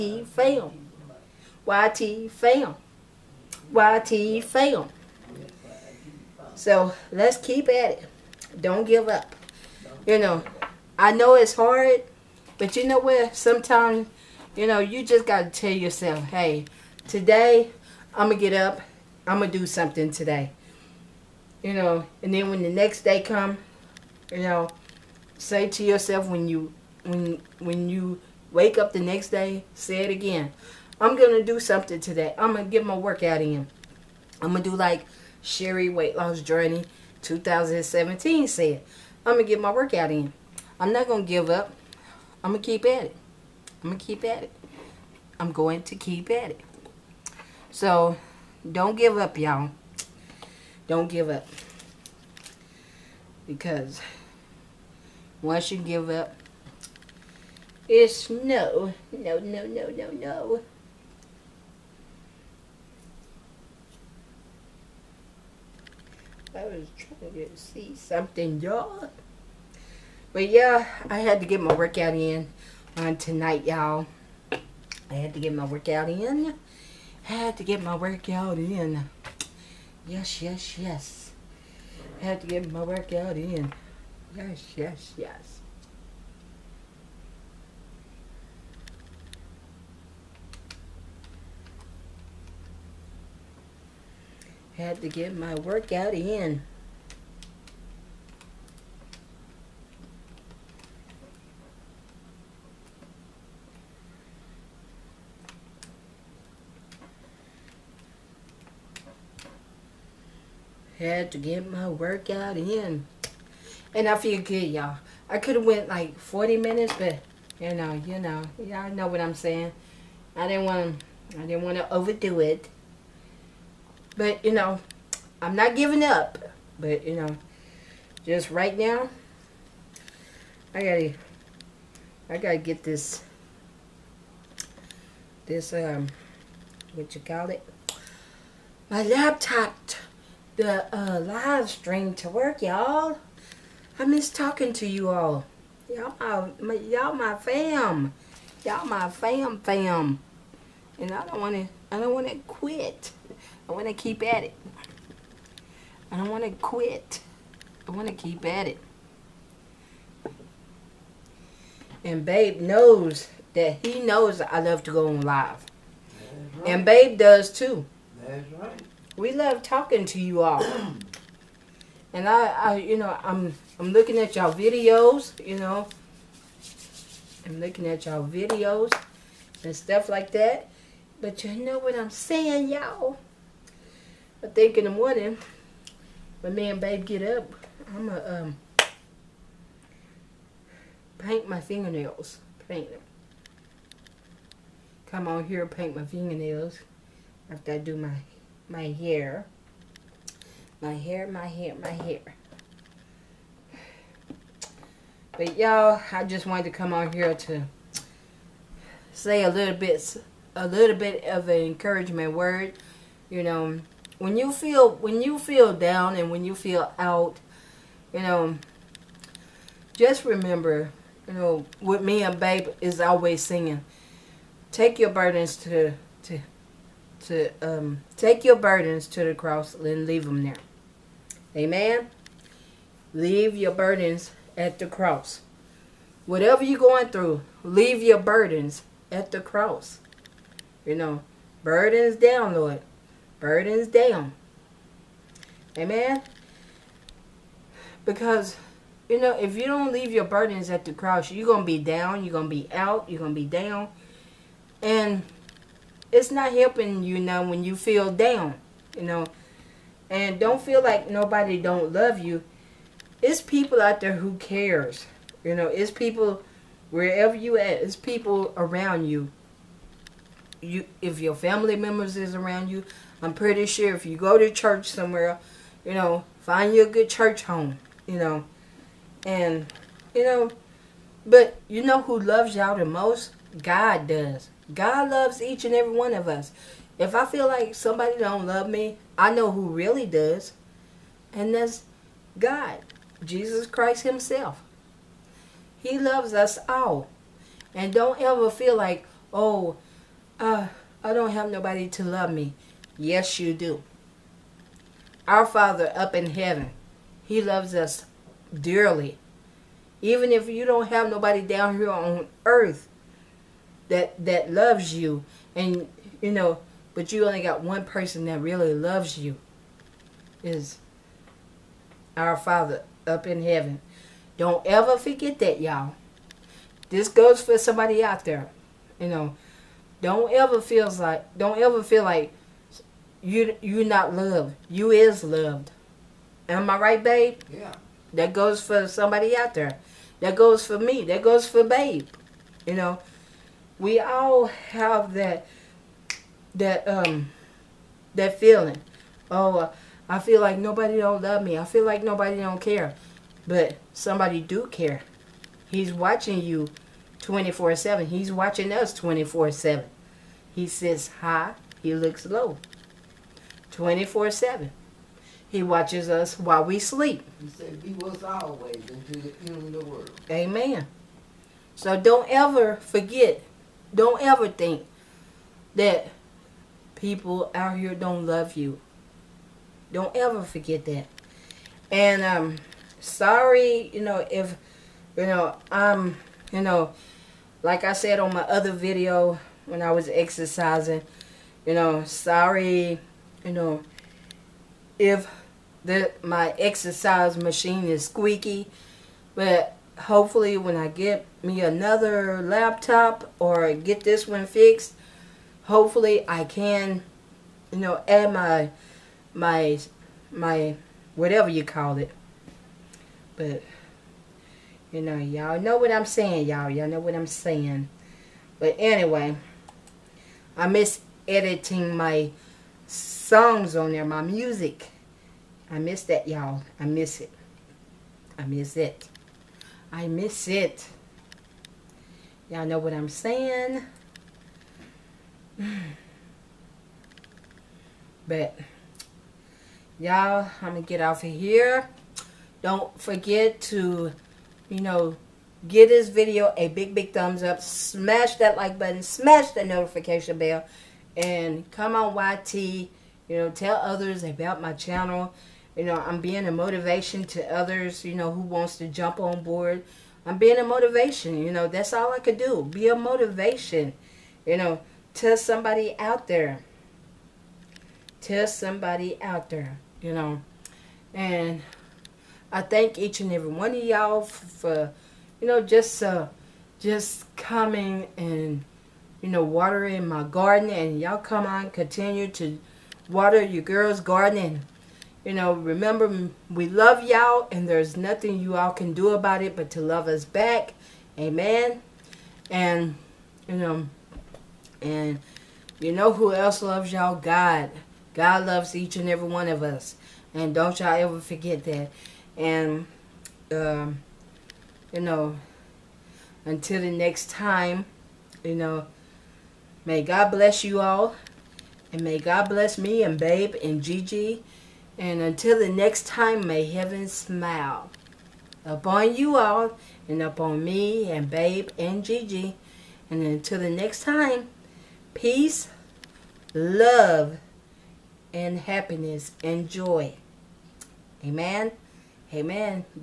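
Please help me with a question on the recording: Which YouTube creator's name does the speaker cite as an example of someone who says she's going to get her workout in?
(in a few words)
Cherrie Weight Loss Journey 2017.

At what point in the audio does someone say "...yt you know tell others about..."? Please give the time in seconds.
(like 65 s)
452 s.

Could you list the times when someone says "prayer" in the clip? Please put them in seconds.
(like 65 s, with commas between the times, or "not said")
not said.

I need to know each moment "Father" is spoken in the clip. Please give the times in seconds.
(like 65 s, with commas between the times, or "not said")
305 s, 322 s.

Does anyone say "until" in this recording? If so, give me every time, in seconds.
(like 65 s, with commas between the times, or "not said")
368 s, 506 s, 515 s, 523 s.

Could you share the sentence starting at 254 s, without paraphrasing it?
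And it's not helping you now when you feel down, you know.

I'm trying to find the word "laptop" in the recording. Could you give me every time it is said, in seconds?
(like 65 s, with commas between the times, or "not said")
139 s, 402 s.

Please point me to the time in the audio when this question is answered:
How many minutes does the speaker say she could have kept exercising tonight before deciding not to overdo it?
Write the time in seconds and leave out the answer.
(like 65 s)
116 s.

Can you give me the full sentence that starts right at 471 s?
And I thank each and every one of y'all for, you know, just uh, just coming and, you know, watering my garden.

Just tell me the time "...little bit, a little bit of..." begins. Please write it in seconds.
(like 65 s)
209 s.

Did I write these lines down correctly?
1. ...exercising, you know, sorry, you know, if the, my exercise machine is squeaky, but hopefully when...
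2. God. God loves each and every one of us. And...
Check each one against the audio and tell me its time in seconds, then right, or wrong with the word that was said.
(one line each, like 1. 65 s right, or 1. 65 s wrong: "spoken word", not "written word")
1. 390 s right
2. 497 s right.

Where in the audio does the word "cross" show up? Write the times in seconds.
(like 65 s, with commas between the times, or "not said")
229 s, 234 s, 239 s, 250 s.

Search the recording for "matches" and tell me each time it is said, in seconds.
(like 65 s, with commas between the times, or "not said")
not said.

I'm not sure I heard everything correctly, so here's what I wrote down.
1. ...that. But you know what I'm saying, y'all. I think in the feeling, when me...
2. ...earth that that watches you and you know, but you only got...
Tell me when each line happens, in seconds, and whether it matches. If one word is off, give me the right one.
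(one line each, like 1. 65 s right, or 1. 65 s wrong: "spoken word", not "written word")
1. 180 s wrong: "morning", not "feeling"
2. 312 s wrong: "loves", not "watches".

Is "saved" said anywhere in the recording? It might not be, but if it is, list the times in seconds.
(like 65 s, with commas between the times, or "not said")
not said.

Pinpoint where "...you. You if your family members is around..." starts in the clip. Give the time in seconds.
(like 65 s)
269 s.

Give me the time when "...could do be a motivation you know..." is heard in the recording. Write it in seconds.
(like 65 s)
462 s.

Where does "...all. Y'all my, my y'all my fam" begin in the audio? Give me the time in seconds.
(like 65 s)
145 s.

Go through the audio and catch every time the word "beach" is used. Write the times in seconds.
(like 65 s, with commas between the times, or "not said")
not said.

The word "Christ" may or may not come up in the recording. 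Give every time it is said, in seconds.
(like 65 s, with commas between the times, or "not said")
293 s.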